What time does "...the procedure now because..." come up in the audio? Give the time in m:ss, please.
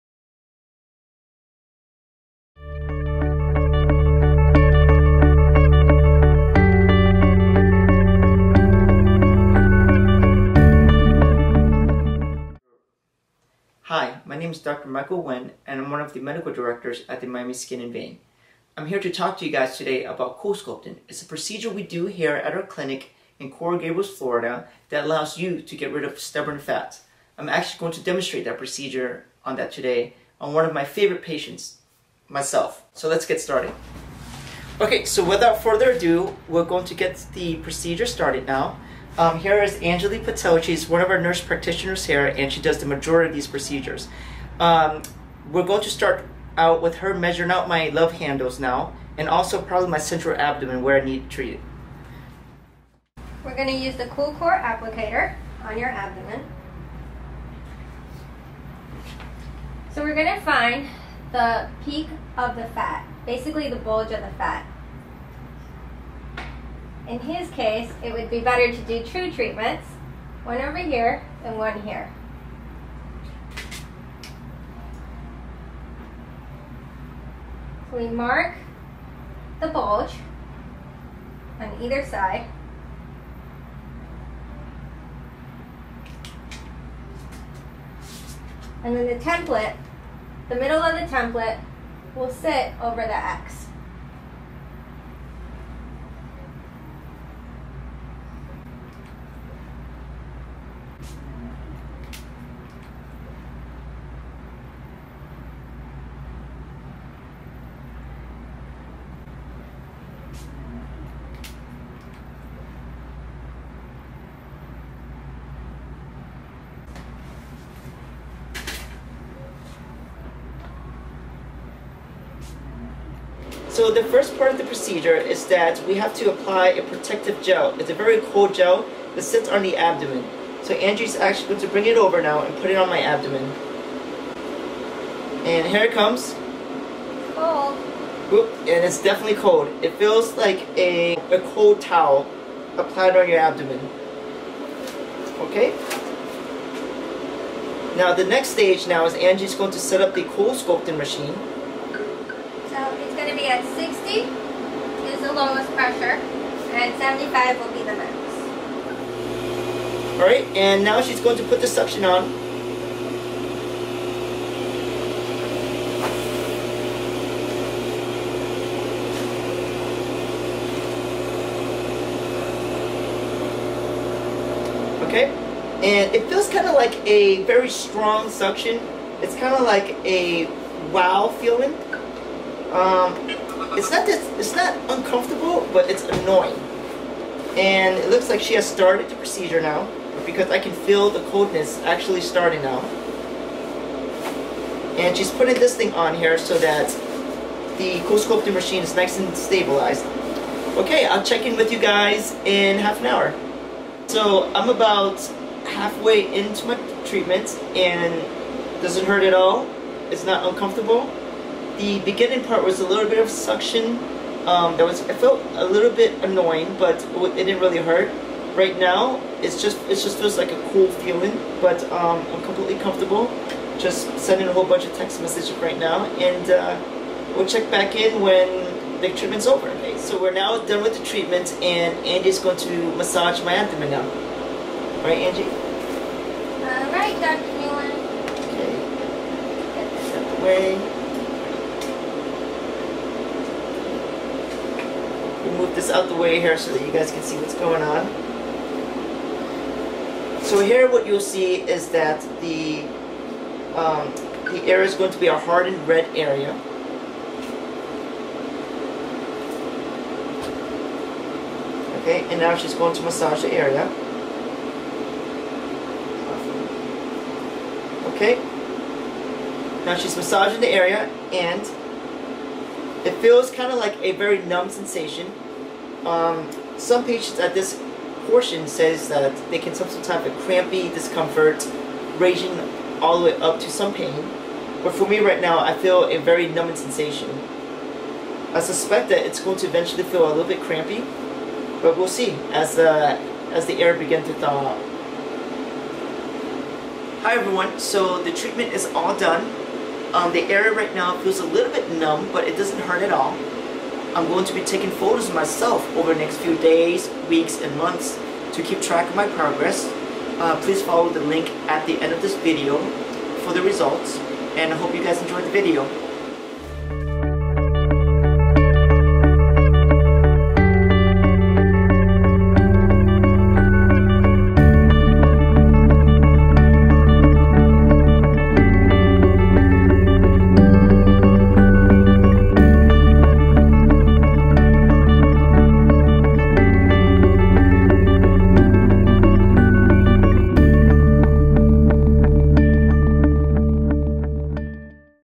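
3:09.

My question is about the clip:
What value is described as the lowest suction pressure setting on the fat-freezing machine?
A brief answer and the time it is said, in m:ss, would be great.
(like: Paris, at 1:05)
60, at 2:33.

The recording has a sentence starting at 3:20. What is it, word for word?
Okay, I'll check in with you guys in half an hour.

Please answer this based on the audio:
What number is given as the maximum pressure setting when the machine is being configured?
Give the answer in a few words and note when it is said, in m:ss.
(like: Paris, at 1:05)
75, at 2:36.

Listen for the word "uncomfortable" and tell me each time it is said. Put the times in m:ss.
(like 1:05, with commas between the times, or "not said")
3:04, 3:30.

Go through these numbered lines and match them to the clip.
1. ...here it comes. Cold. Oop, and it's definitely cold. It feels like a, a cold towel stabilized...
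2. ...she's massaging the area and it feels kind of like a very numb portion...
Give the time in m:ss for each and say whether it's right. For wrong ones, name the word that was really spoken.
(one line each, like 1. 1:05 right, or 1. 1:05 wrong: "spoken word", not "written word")
1. 2:15 wrong: "applied", not "stabilized"
2. 4:29 wrong: "sensation", not "portion".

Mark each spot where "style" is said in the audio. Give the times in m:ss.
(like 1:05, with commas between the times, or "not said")
not said.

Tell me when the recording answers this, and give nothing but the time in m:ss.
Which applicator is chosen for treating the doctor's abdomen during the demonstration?
0:54.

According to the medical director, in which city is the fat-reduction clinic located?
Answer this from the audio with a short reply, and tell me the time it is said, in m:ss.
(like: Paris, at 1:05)
Coral Gables, at 0:23.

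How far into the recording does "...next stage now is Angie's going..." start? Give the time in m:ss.
2:28.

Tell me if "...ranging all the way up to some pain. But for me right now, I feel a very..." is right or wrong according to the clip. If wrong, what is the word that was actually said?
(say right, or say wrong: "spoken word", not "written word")
right.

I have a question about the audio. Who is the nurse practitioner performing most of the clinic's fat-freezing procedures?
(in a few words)
Angeli Patel.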